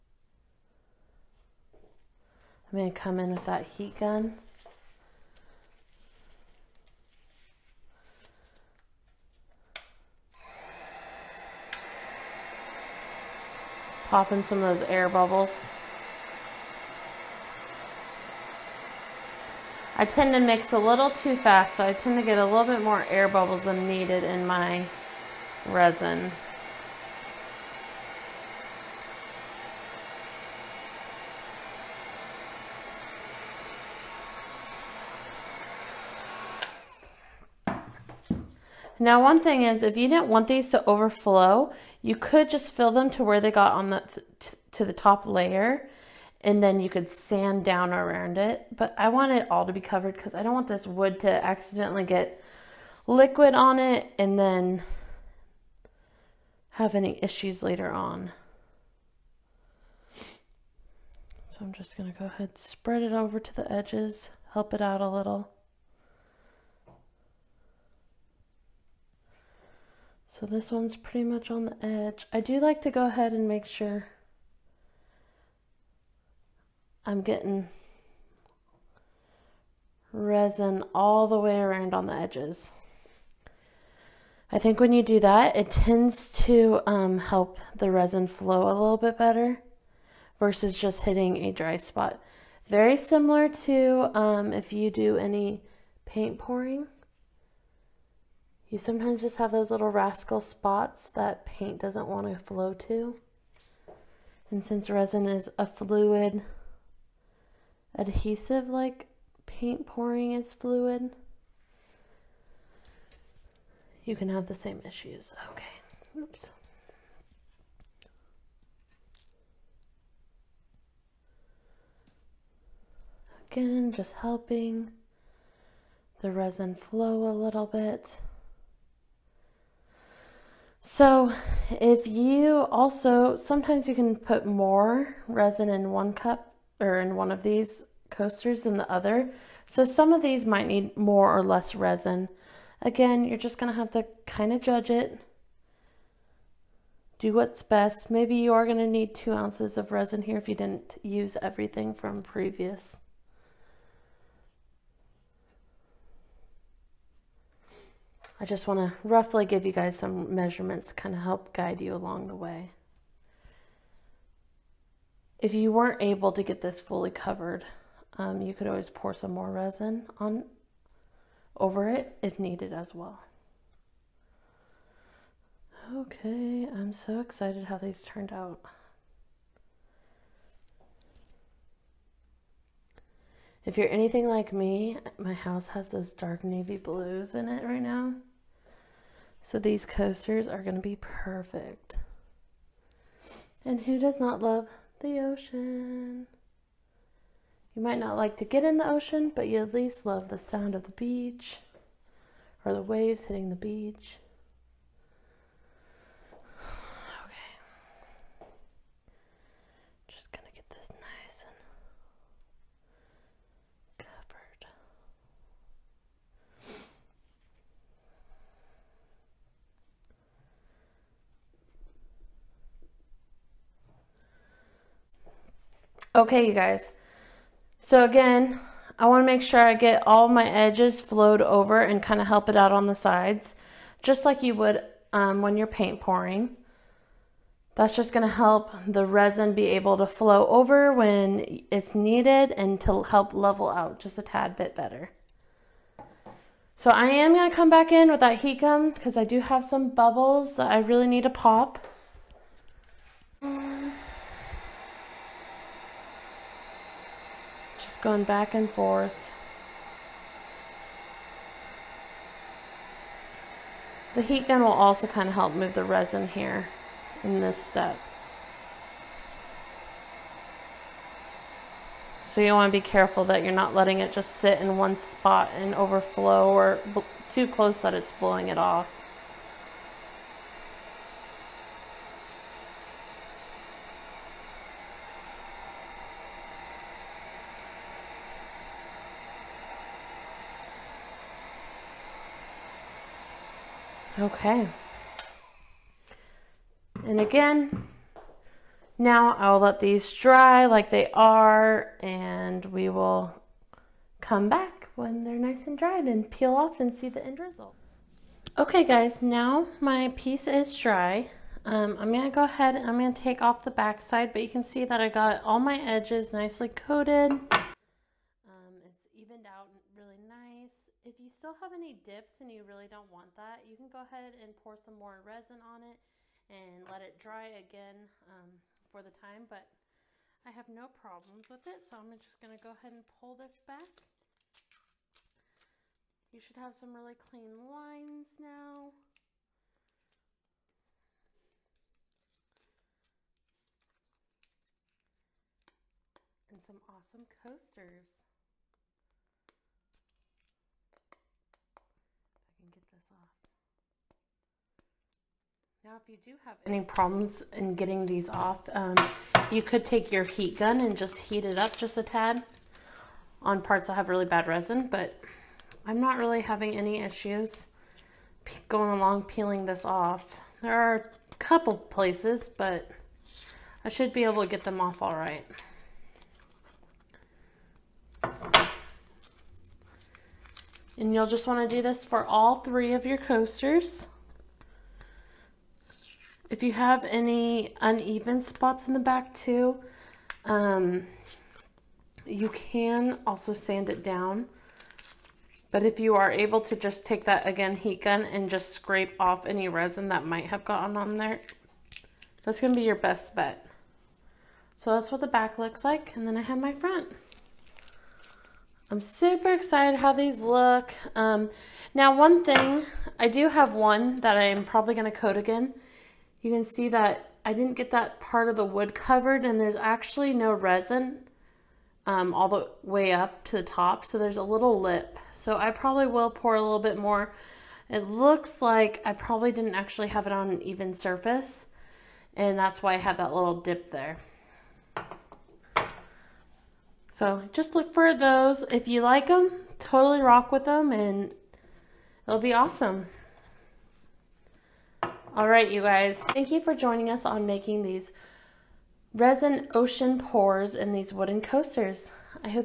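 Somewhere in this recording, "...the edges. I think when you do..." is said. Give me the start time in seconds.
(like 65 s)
82 s.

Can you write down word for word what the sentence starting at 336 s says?
You should have some really clean lines now.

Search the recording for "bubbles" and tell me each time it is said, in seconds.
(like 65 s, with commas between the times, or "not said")
15 s, 23 s, 249 s.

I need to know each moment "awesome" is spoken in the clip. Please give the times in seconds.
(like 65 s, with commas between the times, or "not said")
346 s, 442 s.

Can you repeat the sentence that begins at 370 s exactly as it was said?
There are a couple places, but I should be able to get them off all right.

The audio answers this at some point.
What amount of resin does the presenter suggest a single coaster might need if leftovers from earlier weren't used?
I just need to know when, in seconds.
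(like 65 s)
149 s.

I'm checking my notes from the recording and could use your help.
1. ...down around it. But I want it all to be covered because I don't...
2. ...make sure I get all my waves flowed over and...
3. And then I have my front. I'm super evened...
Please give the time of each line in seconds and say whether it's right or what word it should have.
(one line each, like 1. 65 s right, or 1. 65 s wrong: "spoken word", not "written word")
1. 47 s right
2. 229 s wrong: "edges", not "waves"
3. 406 s wrong: "excited", not "evened".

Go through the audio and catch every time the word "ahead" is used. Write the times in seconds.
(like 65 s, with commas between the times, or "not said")
62 s, 73 s, 312 s, 324 s, 332 s.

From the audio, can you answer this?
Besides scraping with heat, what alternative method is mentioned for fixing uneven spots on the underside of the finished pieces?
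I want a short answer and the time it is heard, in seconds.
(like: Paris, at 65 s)
sand it down, at 393 s.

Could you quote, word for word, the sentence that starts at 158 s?
I just want to roughly give you guys some measurements to kind of help guide you along the way.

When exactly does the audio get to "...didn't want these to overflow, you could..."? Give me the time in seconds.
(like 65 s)
40 s.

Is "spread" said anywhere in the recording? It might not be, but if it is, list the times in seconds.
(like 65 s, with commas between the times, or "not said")
62 s.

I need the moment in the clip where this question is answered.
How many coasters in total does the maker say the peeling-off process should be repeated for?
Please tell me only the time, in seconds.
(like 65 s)
382 s.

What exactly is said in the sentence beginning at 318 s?
Um, it's evened out really nice.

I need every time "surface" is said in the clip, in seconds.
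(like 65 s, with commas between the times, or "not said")
430 s.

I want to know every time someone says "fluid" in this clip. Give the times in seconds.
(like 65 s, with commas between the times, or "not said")
105 s, 110 s.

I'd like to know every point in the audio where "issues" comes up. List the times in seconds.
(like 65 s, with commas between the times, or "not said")
57 s, 114 s, 367 s.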